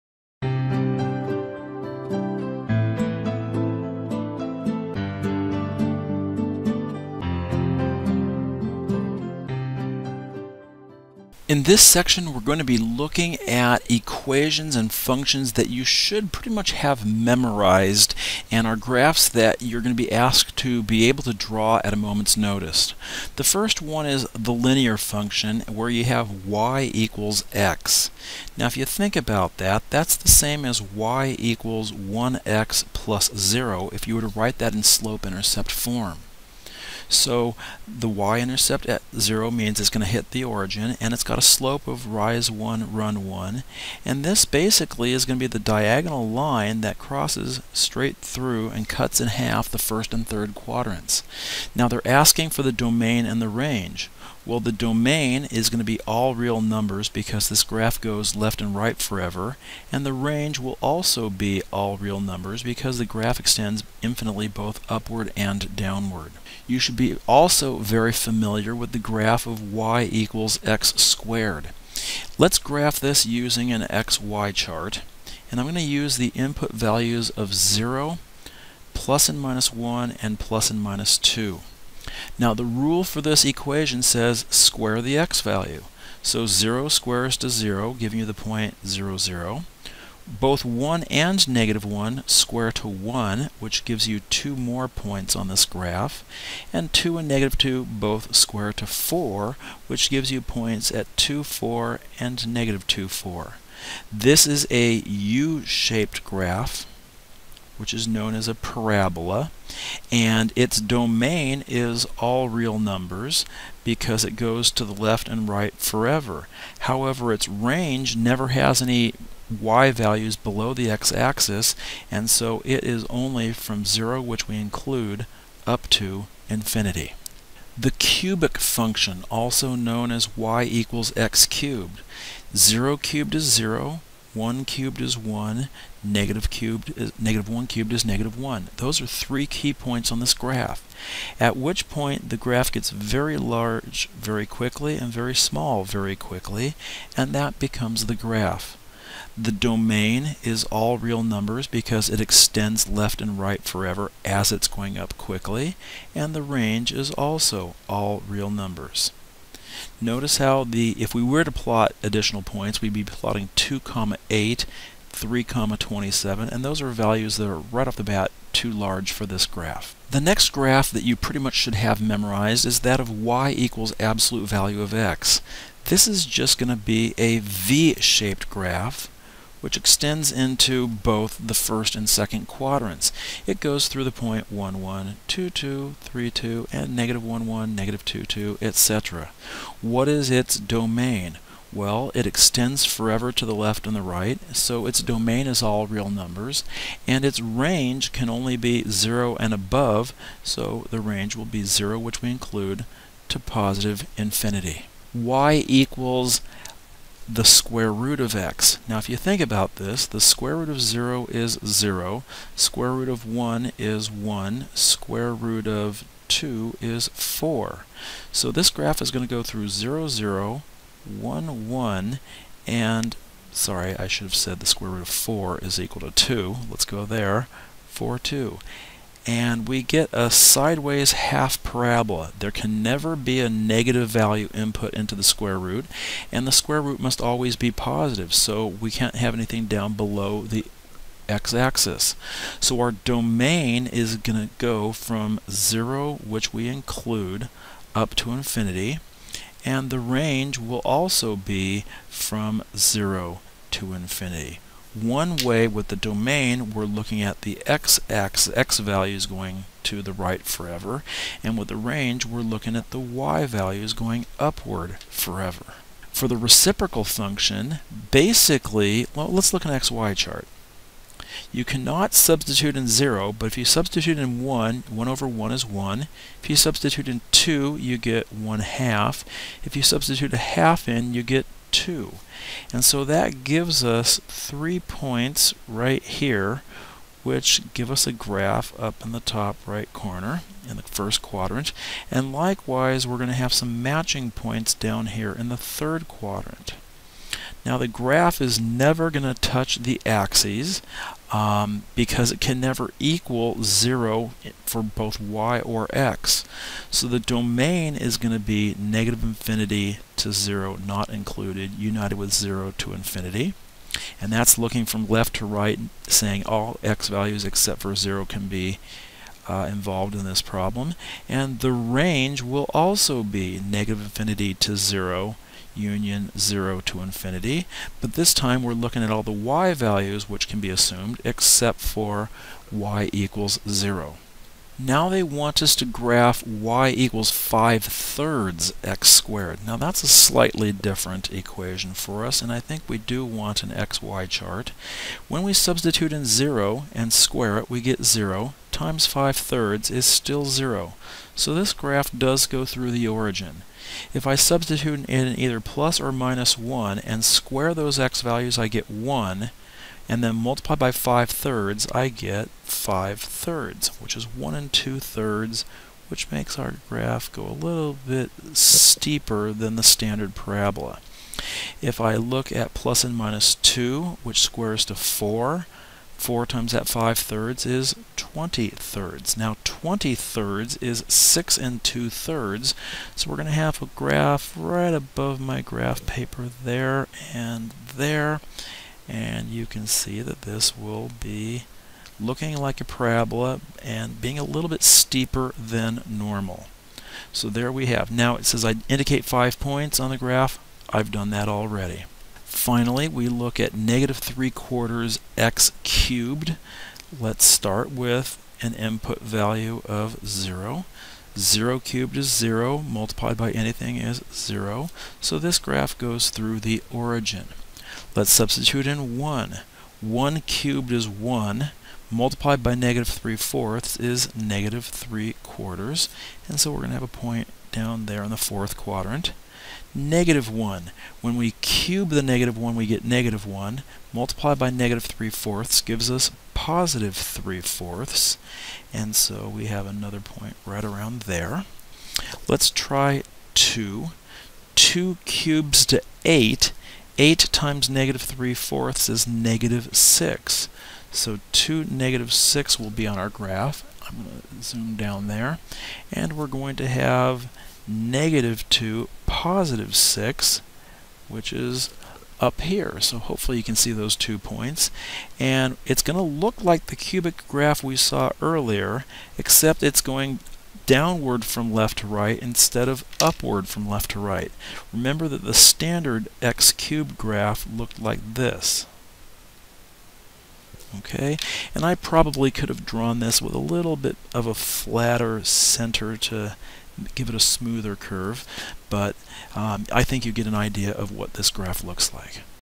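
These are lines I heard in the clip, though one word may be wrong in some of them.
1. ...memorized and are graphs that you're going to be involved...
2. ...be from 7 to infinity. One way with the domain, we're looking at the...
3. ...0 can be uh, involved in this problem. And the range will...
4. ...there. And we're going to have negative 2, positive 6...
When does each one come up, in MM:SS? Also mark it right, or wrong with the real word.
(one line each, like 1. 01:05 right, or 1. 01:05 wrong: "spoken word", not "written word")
1. 00:17 wrong: "asked", not "involved"
2. 04:11 wrong: "0", not "7"
3. 05:17 right
4. 07:35 right.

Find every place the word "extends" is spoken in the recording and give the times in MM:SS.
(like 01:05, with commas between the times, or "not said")
01:03, 02:32, 02:59, 03:12.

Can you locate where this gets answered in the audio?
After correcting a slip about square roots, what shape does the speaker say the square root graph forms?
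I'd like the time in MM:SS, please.
03:50.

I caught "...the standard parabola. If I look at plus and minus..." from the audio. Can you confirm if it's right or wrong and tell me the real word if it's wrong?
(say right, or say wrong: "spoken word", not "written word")
right.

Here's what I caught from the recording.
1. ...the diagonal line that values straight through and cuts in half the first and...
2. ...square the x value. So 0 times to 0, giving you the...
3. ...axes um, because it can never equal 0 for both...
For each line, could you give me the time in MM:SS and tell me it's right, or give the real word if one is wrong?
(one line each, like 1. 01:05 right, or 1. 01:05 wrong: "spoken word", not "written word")
1. 00:45 wrong: "crosses", not "values"
2. 01:24 wrong: "squares", not "times"
3. 05:00 right.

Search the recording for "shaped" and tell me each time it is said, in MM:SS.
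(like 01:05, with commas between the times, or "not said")
01:45, 02:57.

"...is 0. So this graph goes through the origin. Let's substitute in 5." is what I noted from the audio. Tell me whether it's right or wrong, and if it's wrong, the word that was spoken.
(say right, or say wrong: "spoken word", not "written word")
wrong: "1", not "5".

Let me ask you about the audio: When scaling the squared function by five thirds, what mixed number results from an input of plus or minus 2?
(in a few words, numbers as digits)
6 and 2/3.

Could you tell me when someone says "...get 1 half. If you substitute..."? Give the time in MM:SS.
04:37.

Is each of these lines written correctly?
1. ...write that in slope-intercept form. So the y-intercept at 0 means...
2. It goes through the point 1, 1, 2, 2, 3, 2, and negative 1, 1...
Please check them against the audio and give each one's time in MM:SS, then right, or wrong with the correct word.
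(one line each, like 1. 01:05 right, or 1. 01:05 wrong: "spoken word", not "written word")
1. 00:34 right
2. 03:03 right.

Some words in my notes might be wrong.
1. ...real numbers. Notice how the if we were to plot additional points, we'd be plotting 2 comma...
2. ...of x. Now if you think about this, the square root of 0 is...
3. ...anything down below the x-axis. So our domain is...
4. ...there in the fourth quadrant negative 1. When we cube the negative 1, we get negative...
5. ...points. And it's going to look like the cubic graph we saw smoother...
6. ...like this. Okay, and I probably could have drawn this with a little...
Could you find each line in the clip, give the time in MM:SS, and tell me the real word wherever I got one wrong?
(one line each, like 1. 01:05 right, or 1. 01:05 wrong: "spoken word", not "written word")
1. 02:38 right
2. 03:28 right
3. 03:59 right
4. 07:08 right
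5. 07:44 wrong: "earlier", not "smoother"
6. 07:58 right.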